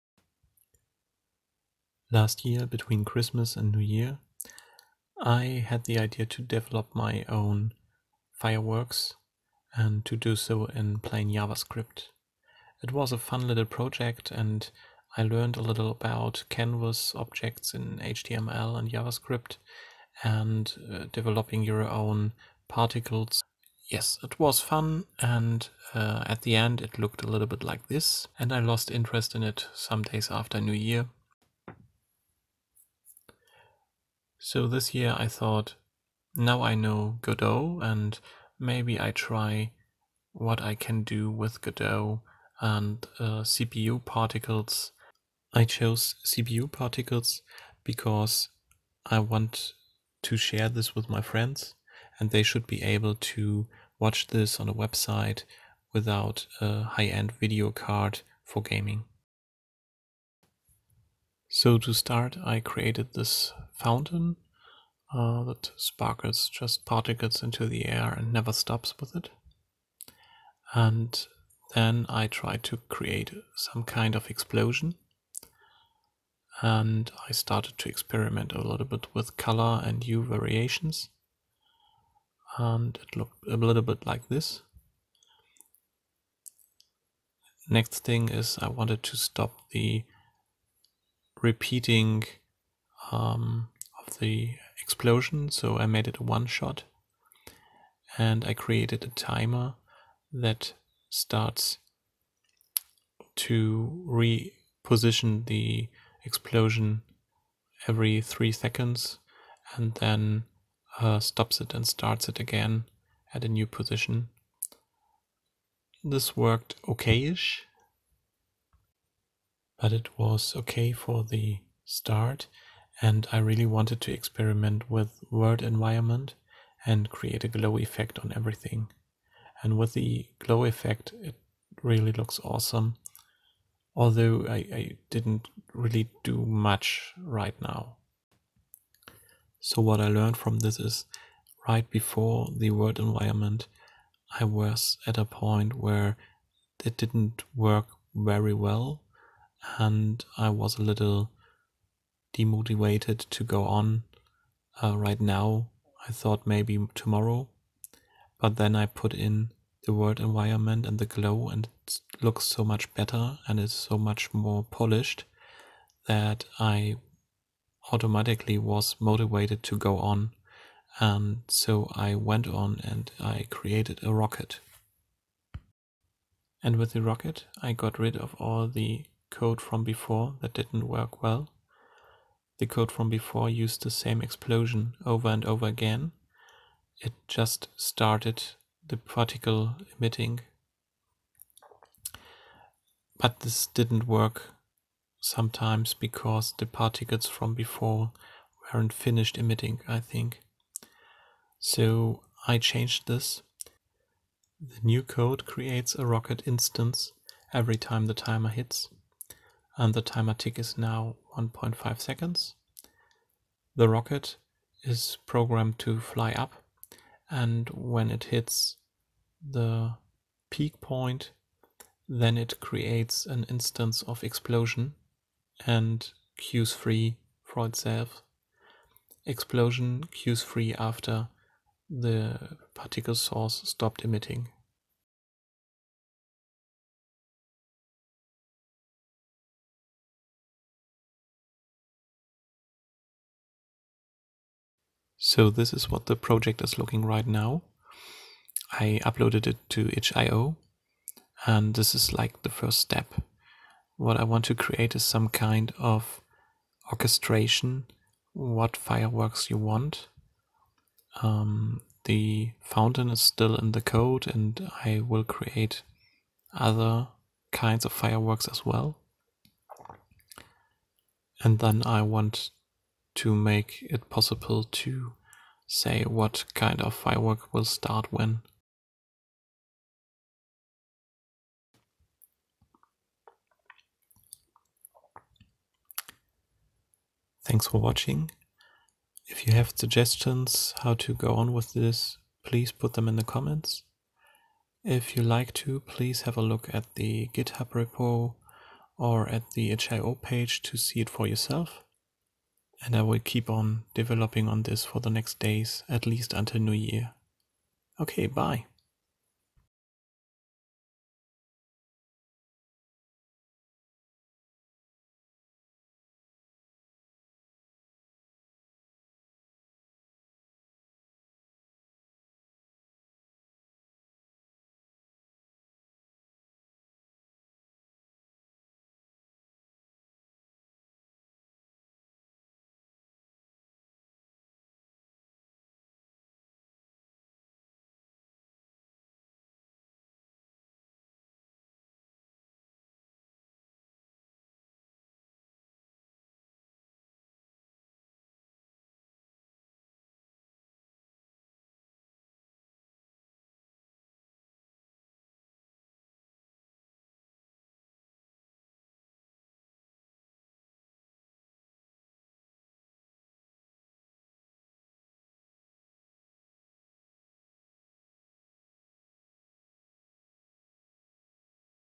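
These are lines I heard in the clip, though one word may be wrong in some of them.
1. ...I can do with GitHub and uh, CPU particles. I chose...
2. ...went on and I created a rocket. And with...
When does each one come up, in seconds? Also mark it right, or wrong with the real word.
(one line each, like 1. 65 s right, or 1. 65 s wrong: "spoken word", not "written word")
1. 40 s wrong: "Godot", not "GitHub"
2. 172 s right.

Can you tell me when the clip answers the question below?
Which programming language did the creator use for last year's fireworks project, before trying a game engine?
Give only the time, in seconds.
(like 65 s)
10 s.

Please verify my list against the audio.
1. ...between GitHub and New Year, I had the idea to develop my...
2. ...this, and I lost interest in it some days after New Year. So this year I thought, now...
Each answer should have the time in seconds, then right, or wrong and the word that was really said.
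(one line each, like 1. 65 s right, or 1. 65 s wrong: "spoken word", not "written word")
1. 2 s wrong: "Christmas", not "GitHub"
2. 27 s right.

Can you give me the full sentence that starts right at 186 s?
It just started the particle emitting.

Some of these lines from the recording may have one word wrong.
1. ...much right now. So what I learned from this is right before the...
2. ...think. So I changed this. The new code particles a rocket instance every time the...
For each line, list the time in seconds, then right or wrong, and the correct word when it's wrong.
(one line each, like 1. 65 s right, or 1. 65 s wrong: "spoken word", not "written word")
1. 136 s right
2. 199 s wrong: "creates", not "particles".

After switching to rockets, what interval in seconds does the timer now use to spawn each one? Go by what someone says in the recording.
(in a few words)
1.5.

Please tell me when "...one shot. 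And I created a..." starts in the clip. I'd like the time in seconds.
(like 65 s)
96 s.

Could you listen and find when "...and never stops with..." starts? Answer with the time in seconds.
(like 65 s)
68 s.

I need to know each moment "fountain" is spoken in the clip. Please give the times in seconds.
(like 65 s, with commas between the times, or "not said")
63 s, 262 s.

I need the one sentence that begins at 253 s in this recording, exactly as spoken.
What I want to create is some kind of orchestration, what fireworks you want.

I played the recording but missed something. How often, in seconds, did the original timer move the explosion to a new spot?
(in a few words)
3.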